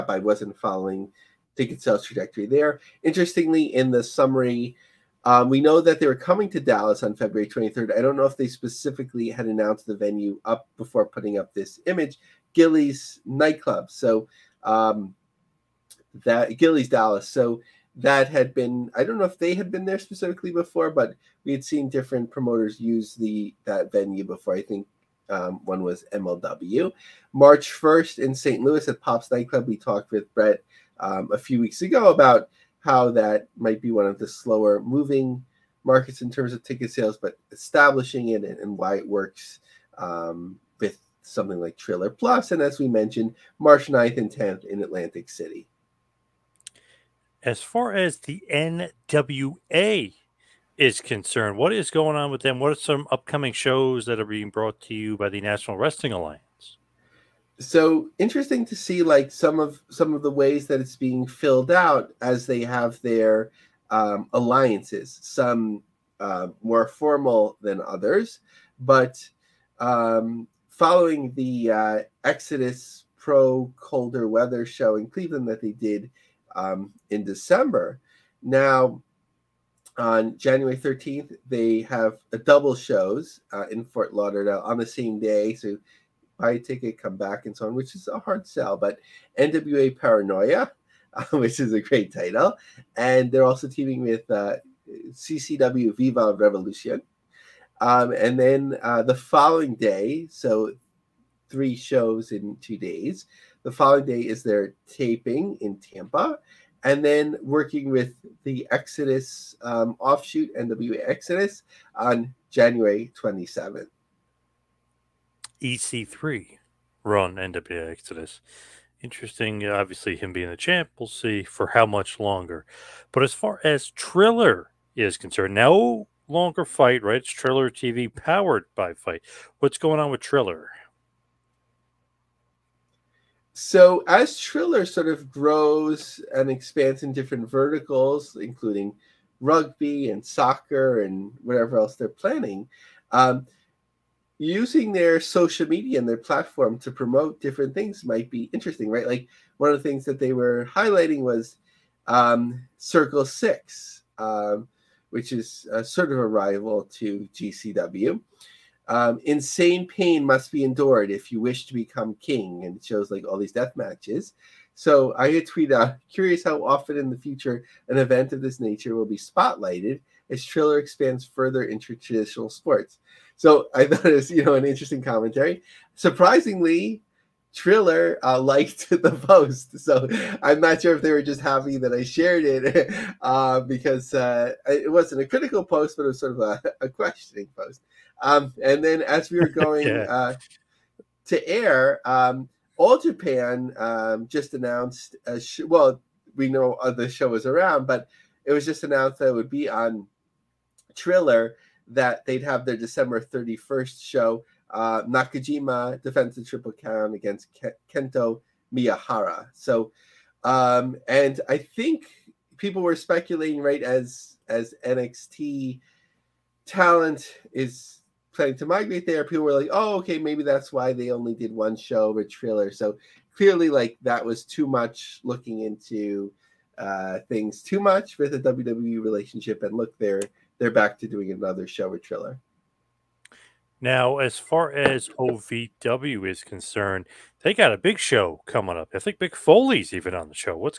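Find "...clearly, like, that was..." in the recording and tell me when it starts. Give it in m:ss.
3:43.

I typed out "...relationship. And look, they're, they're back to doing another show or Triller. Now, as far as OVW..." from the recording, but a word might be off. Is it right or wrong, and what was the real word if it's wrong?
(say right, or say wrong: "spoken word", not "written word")
right.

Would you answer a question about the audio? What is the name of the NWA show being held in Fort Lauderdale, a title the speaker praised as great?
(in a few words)
NWA Paranoia.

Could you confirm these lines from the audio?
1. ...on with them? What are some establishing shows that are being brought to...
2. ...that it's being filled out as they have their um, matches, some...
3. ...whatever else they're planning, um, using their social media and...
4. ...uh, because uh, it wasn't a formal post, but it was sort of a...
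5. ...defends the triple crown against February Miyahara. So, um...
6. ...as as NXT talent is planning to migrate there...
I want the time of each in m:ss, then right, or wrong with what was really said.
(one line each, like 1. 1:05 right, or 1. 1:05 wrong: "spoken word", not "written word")
1. 0:52 wrong: "upcoming", not "establishing"
2. 1:00 wrong: "alliances", not "matches"
3. 2:21 right
4. 3:03 wrong: "critical", not "formal"
5. 3:26 wrong: "Kento", not "February"
6. 3:33 right.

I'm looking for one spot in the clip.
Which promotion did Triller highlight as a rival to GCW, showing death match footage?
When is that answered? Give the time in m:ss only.
2:32.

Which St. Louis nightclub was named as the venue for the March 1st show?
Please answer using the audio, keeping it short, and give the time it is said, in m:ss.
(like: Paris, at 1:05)
Pops Nightclub, at 0:28.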